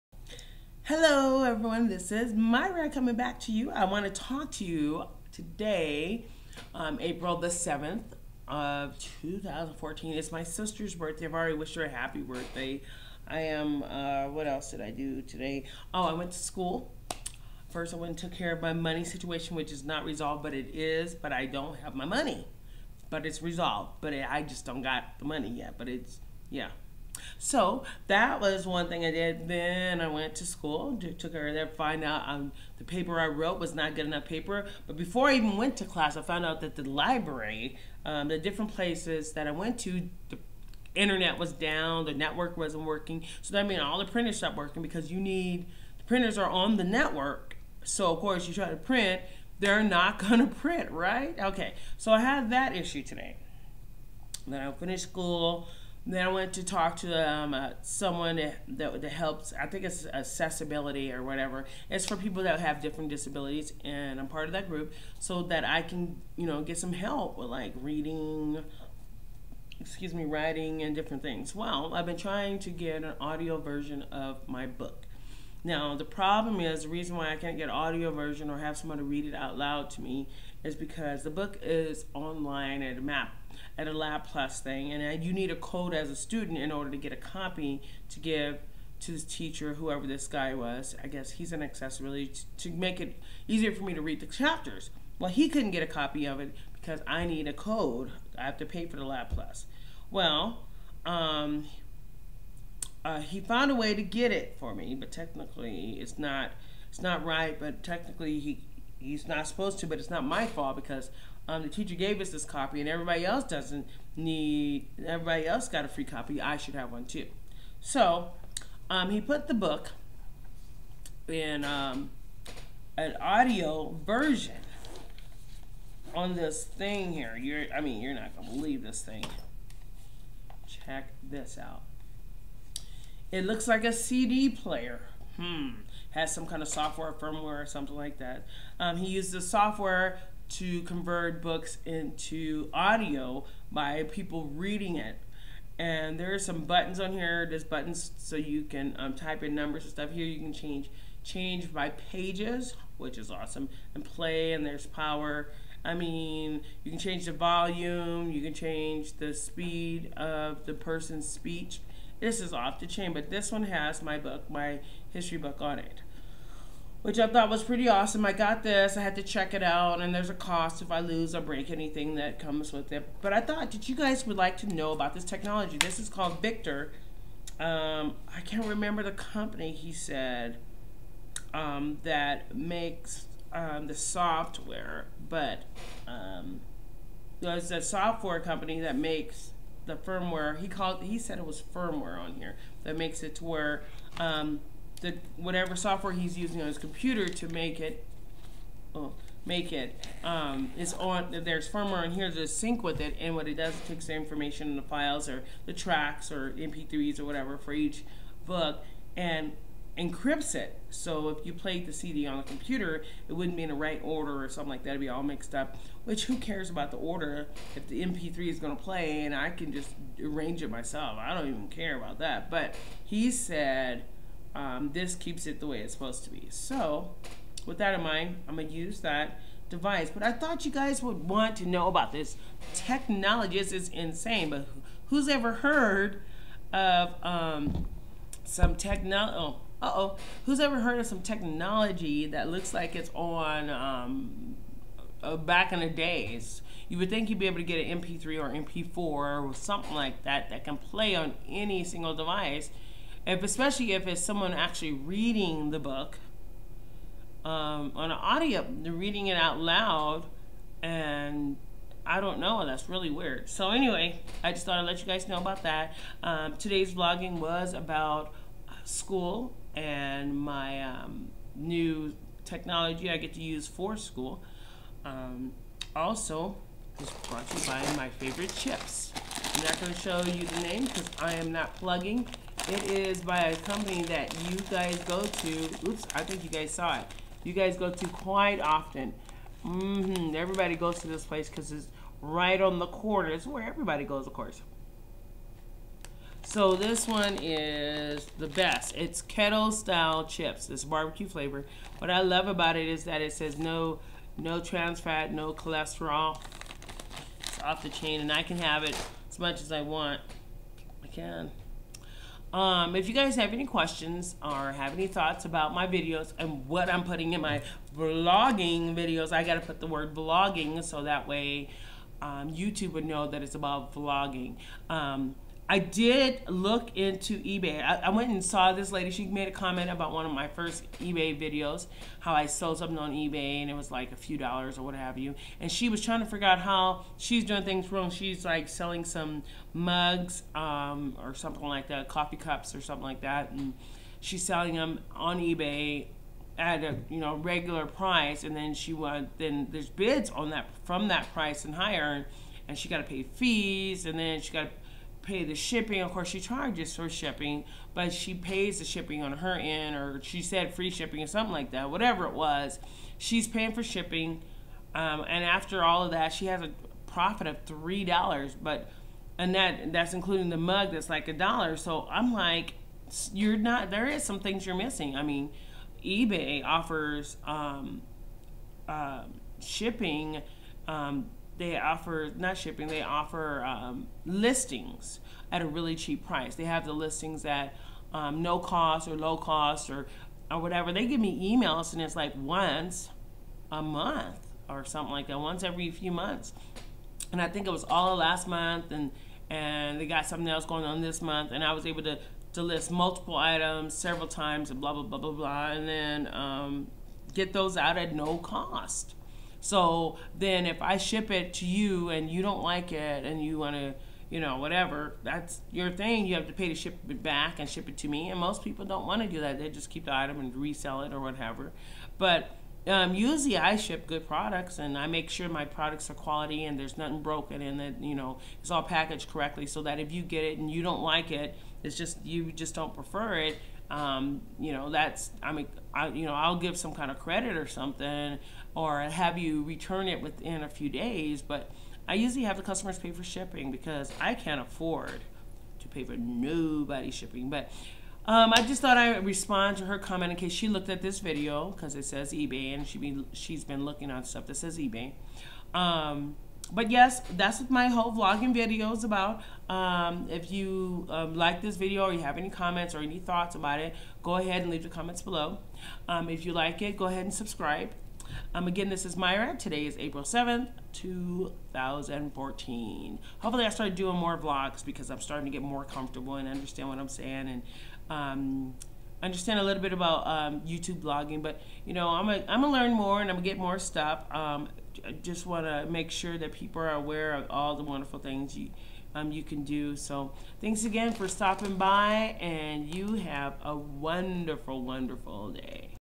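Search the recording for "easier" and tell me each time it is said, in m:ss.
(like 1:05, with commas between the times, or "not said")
1:33.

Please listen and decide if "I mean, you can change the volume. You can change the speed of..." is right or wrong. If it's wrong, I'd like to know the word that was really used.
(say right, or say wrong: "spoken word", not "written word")
right.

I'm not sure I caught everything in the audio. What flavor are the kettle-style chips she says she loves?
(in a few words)
Barbecue.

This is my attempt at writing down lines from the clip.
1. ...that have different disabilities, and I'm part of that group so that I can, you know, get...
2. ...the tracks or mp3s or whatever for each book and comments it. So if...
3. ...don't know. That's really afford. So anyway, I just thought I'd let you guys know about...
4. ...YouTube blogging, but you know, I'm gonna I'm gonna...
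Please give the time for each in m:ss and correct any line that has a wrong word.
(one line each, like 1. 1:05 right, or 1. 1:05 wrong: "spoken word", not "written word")
1. 1:02 right
2. 3:25 wrong: "encrypts", not "comments"
3. 4:22 wrong: "weird", not "afford"
4. 8:00 right.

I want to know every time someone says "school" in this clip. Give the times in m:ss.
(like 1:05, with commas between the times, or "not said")
0:16, 0:30, 0:55, 4:28, 4:33.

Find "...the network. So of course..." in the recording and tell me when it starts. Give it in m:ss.
0:46.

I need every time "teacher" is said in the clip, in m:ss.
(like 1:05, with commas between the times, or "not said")
1:29, 1:51.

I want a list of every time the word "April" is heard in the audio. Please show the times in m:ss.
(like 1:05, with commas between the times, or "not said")
0:06, 7:49.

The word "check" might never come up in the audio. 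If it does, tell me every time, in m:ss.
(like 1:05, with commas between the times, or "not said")
2:10, 2:49.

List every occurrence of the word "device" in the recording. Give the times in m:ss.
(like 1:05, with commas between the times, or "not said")
3:49, 4:12.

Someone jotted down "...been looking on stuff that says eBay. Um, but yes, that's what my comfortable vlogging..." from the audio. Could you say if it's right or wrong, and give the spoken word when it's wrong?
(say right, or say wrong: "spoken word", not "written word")
wrong: "whole", not "comfortable".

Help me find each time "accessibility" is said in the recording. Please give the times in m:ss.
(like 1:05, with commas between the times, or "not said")
1:00, 1:31.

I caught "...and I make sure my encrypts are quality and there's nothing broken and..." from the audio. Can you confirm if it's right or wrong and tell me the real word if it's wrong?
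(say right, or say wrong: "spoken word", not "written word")
wrong: "products", not "encrypts".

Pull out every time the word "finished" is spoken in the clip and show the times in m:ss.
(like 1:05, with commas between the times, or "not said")
0:54.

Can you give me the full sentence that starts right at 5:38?
She's like selling some mugs um, or something like that, coffee cups or something like that.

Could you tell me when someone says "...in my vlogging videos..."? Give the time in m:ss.
5:17.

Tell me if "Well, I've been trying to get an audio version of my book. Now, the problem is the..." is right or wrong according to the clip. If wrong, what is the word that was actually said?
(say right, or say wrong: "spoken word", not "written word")
right.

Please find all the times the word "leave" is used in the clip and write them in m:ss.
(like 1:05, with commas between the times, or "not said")
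7:44.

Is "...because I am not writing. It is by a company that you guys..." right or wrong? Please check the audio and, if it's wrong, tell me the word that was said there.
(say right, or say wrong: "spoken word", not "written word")
wrong: "plugging", not "writing".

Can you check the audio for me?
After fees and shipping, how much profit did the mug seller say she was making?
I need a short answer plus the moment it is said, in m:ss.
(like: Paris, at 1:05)
$3, at 6:07.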